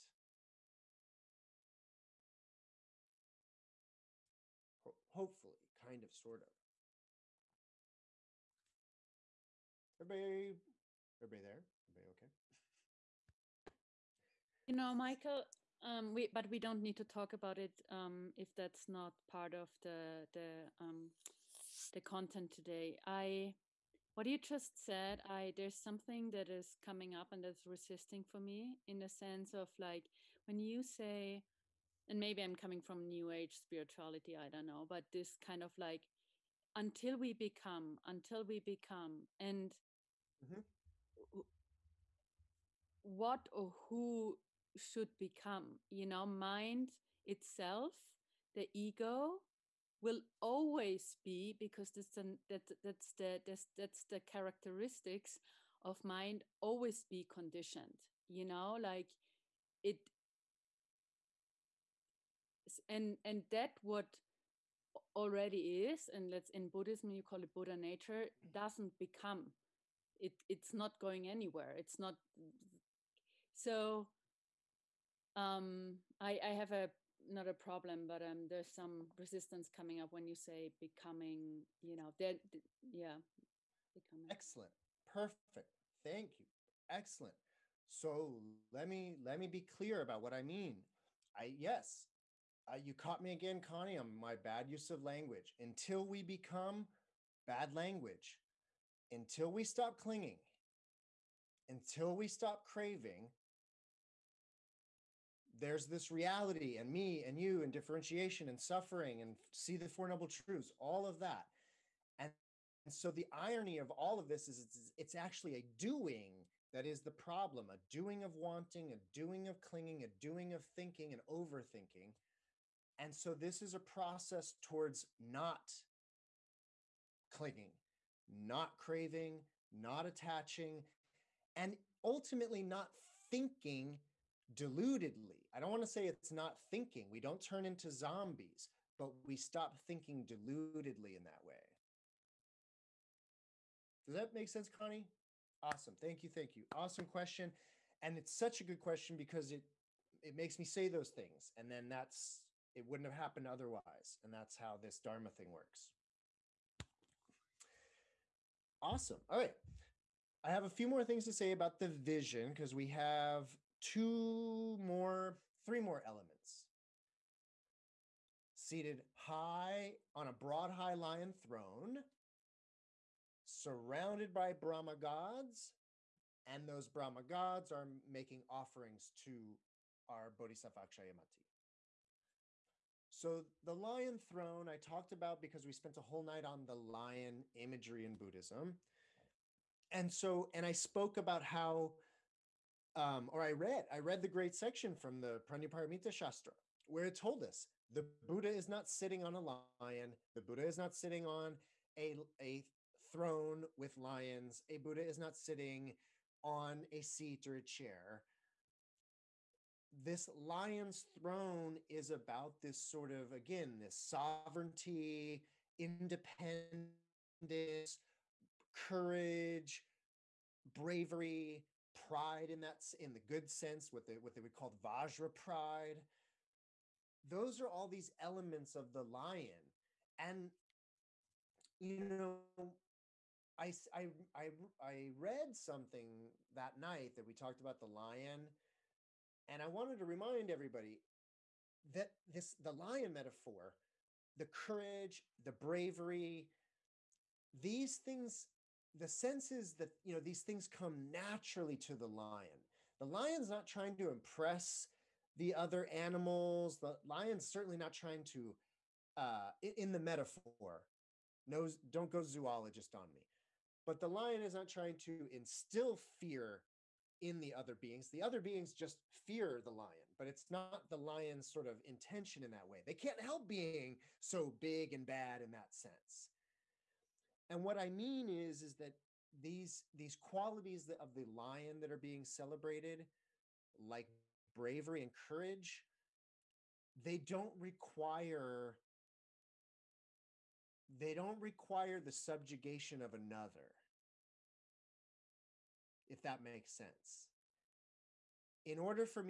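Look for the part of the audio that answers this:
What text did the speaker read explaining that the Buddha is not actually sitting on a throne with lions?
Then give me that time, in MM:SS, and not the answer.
03:15.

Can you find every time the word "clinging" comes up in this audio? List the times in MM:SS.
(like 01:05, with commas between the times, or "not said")
01:39, 01:59, 02:07.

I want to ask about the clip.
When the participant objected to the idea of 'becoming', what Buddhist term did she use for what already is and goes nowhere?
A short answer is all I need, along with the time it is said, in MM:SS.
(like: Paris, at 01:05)
Buddha nature, at 01:07.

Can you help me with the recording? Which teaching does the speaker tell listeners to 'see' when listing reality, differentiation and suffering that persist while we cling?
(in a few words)
The four noble truths.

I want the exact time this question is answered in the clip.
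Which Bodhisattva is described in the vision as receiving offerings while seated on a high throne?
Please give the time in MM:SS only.
03:00.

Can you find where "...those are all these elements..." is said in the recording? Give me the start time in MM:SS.
03:47.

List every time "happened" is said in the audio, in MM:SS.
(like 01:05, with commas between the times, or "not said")
02:33.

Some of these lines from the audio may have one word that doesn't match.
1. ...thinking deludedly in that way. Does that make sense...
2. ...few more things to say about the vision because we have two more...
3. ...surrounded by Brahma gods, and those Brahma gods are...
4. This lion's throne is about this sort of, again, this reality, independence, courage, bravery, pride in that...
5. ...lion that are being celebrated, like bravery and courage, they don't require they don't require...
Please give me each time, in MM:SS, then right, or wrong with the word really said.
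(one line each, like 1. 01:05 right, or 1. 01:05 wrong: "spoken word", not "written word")
1. 02:19 right
2. 02:40 right
3. 02:53 right
4. 03:29 wrong: "sovereignty", not "reality"
5. 04:41 right.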